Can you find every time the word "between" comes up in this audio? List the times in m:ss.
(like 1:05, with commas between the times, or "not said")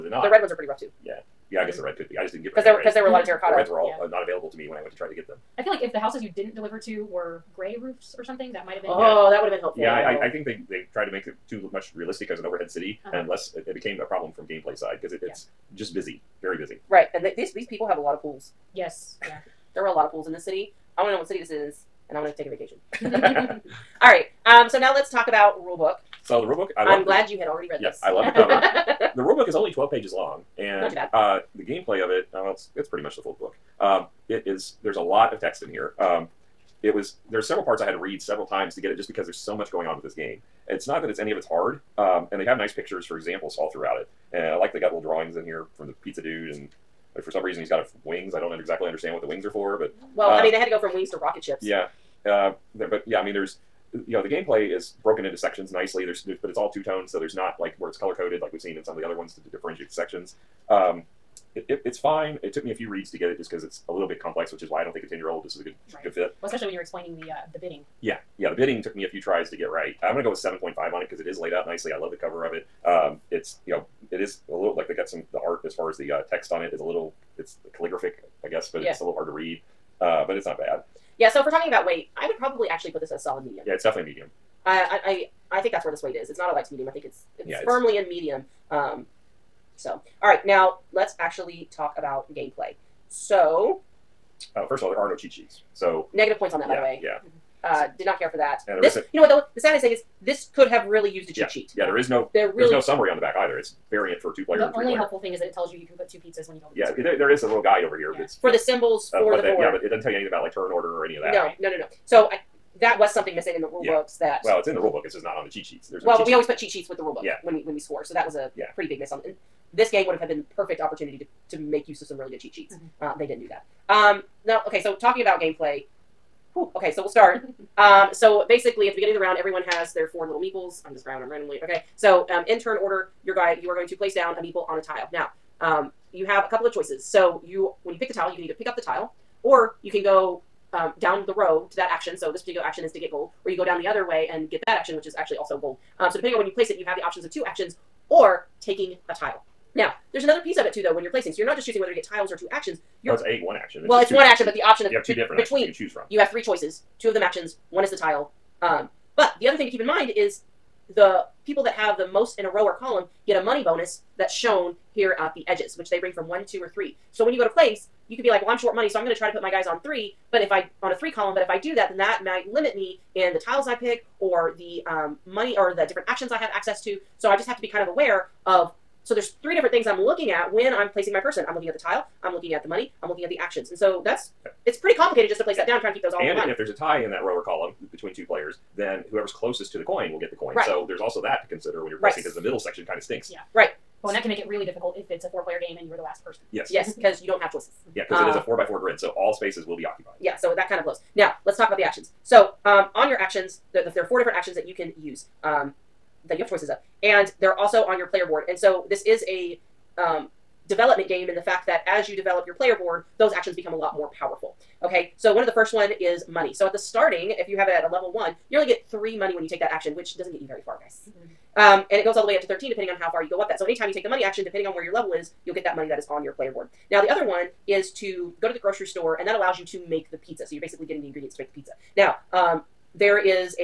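2:35, 3:07.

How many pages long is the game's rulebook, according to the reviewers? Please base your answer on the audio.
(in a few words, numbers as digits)
12.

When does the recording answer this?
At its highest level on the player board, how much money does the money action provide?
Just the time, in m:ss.
3:42.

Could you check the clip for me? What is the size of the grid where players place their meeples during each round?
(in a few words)
4 by 4.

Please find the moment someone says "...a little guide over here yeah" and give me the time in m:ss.
1:47.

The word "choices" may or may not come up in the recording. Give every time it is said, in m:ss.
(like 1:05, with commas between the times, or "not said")
2:16, 2:36, 3:17, 3:26.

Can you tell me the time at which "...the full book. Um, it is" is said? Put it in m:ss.
0:33.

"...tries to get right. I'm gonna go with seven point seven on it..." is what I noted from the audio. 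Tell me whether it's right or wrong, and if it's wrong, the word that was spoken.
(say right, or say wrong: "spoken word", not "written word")
wrong: "five", not "seven".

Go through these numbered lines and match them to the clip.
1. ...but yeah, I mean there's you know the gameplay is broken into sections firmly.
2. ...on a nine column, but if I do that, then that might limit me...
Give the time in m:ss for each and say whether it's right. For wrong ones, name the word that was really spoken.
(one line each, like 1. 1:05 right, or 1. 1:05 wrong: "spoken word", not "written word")
1. 0:52 wrong: "nicely", not "firmly"
2. 2:50 wrong: "three", not "nine".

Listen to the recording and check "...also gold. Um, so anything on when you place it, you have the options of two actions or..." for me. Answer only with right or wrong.
wrong.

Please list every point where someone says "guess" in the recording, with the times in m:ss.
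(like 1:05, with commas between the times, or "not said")
0:01, 1:18.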